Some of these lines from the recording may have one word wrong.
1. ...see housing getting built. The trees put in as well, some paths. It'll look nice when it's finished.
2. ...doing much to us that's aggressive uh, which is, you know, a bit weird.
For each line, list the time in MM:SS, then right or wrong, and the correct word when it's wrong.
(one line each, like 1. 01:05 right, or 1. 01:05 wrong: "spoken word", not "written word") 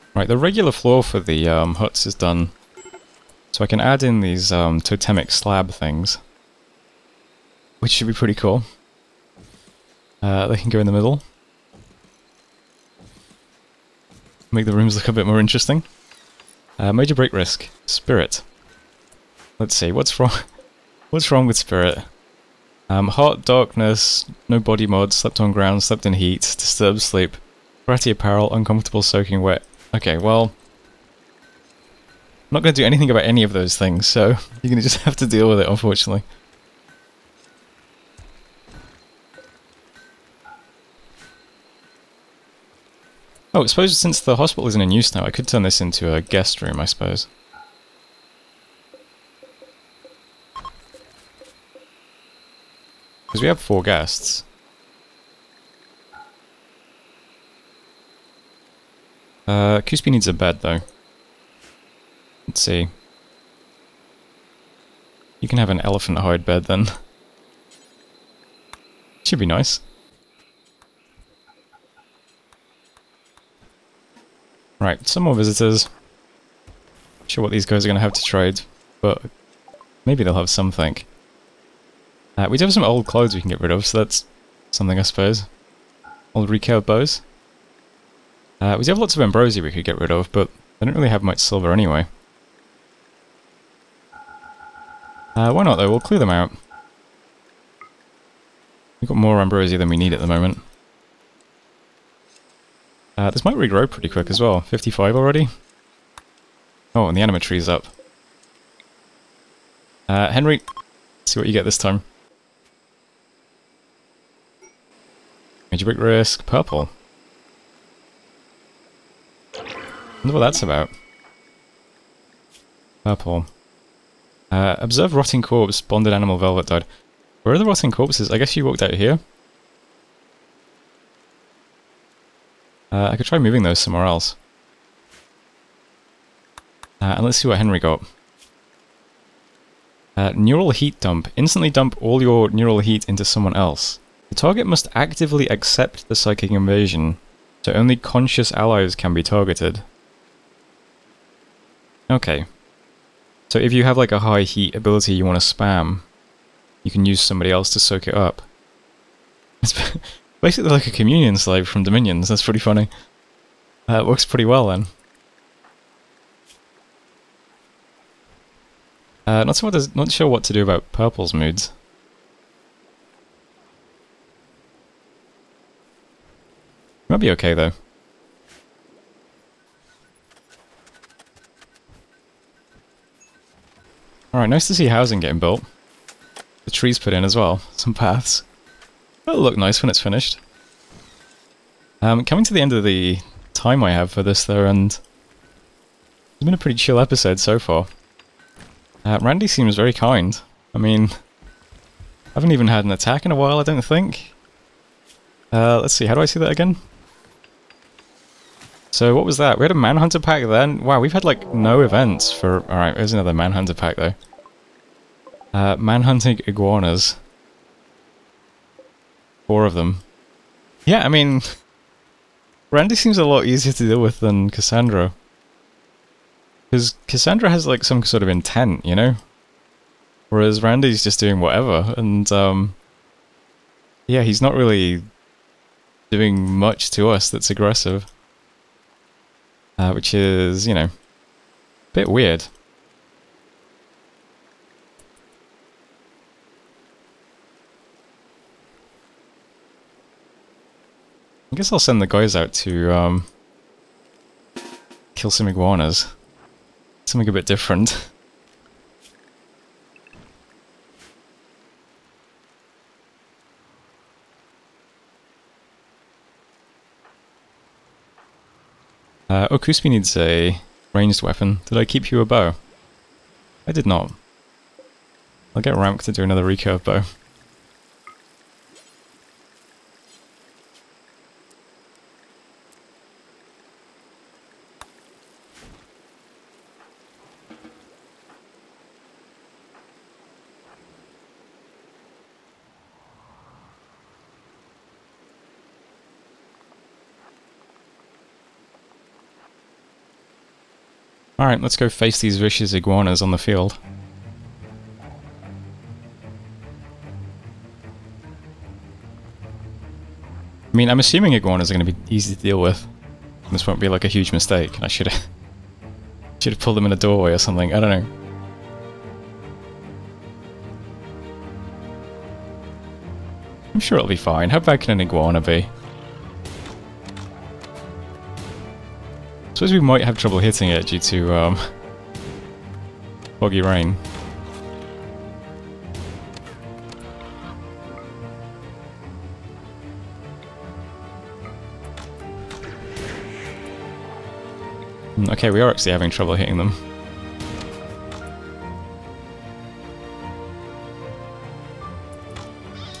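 1. 03:04 right
2. 03:56 right.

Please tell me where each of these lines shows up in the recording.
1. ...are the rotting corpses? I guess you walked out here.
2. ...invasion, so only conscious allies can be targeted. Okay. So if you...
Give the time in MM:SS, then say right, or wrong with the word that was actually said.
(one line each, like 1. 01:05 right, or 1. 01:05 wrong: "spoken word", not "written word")
1. 02:07 right
2. 02:26 right.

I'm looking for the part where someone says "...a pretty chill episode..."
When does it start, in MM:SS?
03:16.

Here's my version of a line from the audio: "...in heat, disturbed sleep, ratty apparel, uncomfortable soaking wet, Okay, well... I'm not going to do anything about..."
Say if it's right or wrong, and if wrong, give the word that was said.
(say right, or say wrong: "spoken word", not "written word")
right.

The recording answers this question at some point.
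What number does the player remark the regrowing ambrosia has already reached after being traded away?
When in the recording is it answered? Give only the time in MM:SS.
01:44.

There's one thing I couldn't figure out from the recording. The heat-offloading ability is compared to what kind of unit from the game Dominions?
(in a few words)
Communion slave.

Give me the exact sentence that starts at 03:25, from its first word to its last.
Uh, let's see, how do I see that again?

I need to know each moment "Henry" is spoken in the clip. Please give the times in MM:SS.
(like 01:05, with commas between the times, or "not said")
01:50, 02:17.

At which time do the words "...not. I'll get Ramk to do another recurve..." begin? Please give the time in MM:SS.
04:33.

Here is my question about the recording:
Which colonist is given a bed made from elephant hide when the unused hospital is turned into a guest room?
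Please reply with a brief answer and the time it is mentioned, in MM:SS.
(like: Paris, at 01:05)
Cuspy, at 00:59.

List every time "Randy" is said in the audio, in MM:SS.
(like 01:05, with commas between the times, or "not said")
03:19, 03:42, 03:50.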